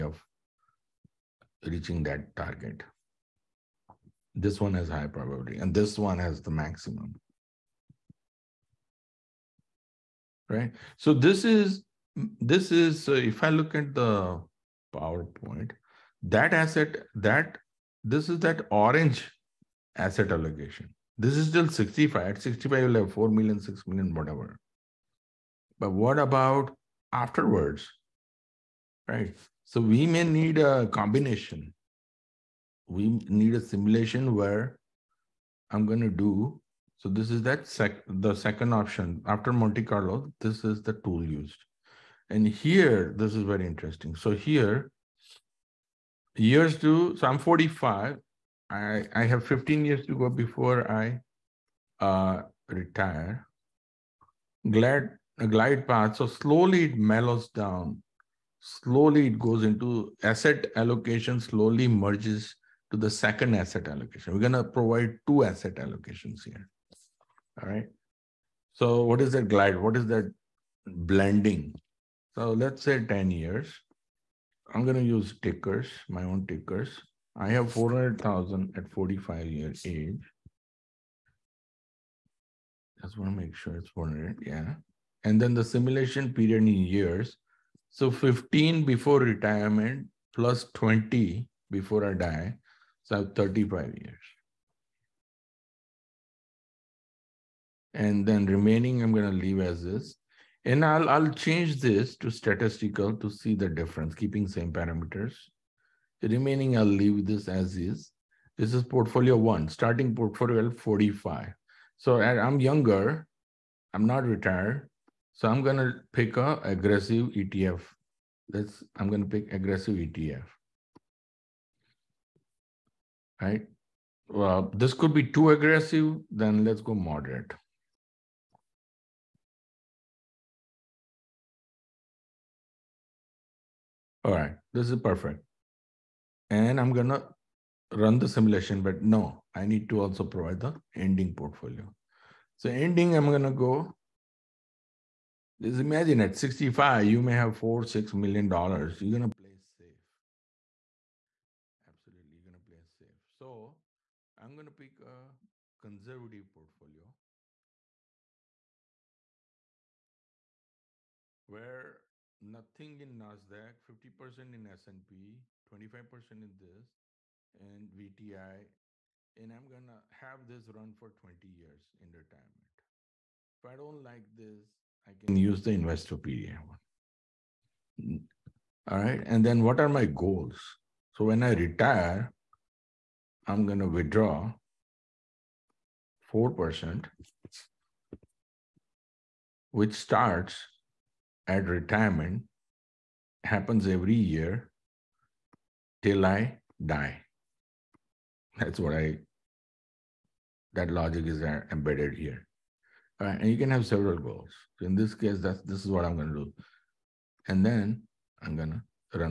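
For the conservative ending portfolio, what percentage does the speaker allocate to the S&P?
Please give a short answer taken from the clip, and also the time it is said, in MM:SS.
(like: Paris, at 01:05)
50%, at 02:43.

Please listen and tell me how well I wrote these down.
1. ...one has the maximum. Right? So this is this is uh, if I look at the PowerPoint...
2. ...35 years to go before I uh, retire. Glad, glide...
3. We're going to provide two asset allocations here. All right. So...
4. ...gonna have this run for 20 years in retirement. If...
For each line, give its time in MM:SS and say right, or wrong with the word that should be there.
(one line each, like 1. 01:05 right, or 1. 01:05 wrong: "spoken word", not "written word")
1. 00:05 right
2. 00:49 wrong: "15", not "35"
3. 01:04 right
4. 02:49 right.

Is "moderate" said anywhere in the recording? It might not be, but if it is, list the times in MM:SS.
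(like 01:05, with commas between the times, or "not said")
02:06.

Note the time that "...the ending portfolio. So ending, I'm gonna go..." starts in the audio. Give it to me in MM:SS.
02:20.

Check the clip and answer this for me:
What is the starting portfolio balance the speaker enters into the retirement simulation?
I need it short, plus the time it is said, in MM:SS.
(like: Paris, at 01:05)
400,000, at 01:17.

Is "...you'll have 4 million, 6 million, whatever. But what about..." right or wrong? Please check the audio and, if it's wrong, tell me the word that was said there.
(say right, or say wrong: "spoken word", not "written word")
right.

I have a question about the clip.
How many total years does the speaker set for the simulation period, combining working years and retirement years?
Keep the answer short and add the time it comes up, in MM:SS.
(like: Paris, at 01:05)
35, at 01:33.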